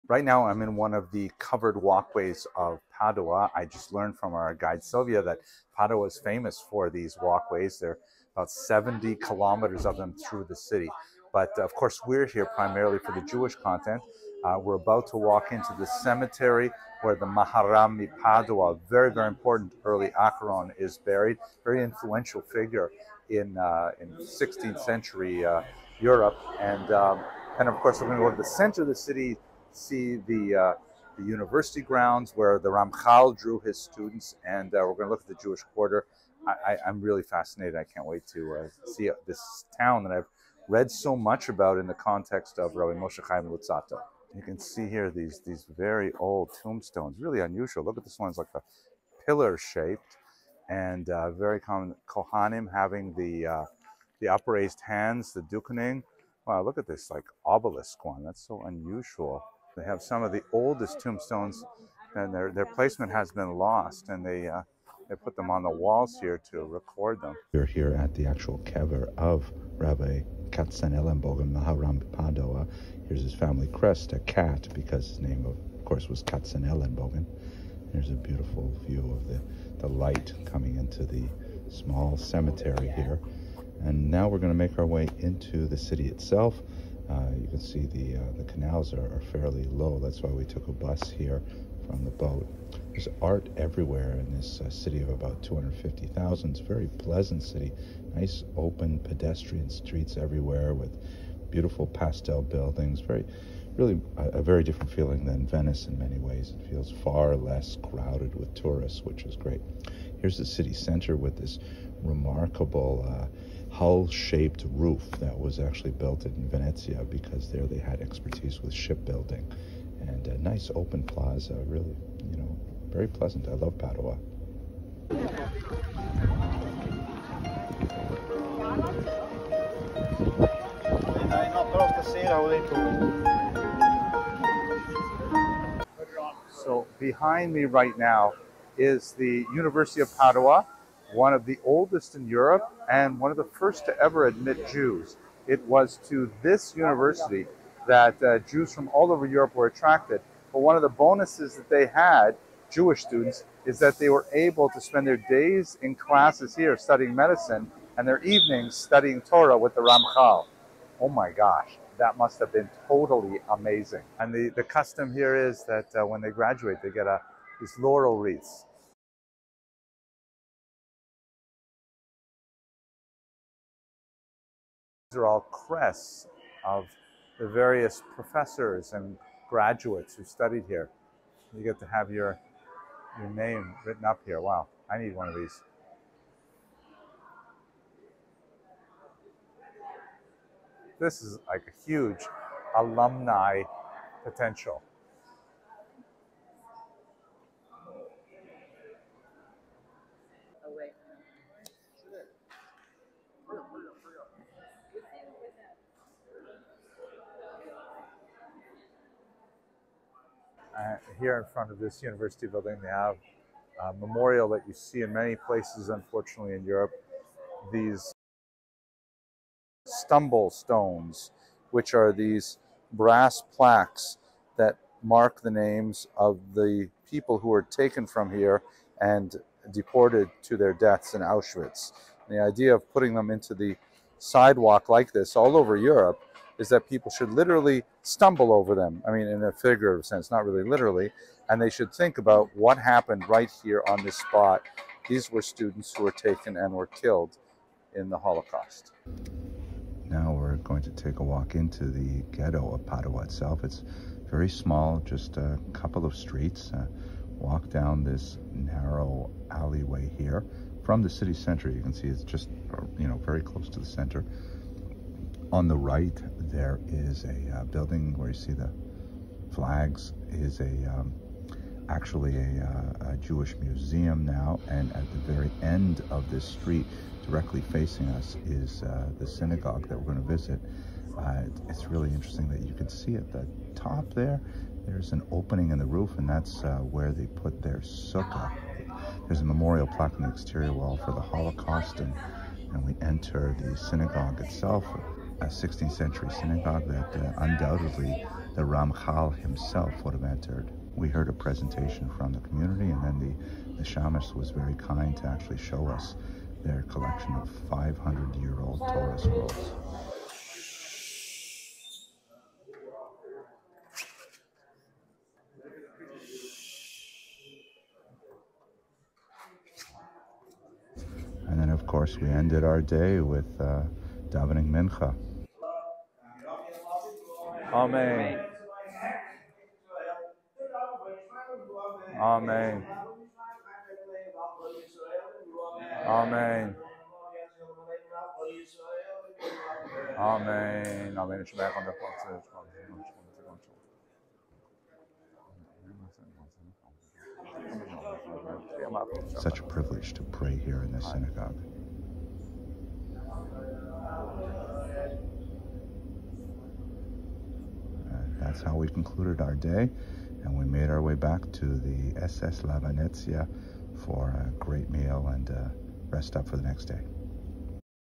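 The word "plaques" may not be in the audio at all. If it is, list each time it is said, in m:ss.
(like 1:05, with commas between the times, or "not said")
3:43, 4:49.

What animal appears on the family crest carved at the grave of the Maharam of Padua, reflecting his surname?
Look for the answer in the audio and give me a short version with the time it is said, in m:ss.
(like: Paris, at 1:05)
A cat, at 1:14.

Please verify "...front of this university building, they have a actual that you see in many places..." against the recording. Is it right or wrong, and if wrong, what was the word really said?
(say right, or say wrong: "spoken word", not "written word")
wrong: "memorial", not "actual".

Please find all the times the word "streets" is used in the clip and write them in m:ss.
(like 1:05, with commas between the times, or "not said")
1:39, 4:16, 4:36.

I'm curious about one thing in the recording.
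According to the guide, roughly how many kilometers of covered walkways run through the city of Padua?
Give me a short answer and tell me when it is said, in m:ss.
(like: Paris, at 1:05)
70 kilometers, at 0:08.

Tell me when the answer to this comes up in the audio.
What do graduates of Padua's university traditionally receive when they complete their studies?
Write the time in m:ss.
2:47.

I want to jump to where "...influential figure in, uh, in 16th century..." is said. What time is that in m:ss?
0:21.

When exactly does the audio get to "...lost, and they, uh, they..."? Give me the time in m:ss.
1:03.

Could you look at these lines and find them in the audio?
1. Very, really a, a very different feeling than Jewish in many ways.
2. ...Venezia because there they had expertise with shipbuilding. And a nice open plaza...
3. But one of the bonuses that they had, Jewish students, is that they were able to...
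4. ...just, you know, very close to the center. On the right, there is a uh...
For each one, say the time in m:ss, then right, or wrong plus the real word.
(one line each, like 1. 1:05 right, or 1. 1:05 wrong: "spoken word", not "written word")
1. 1:43 wrong: "Venice", not "Jewish"
2. 1:56 right
3. 2:30 right
4. 4:22 right.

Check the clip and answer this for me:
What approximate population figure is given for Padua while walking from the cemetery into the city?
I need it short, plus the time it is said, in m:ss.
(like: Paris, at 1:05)
250,000, at 1:35.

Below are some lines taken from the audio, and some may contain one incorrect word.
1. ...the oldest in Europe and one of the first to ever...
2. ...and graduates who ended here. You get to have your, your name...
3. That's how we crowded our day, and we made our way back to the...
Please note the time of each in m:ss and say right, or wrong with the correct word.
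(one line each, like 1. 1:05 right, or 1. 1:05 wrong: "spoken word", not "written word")
1. 2:21 right
2. 2:58 wrong: "studied", not "ended"
3. 5:58 wrong: "concluded", not "crowded".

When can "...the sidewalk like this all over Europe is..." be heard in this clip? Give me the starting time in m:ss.
3:53.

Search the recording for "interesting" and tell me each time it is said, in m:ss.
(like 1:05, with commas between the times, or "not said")
4:42.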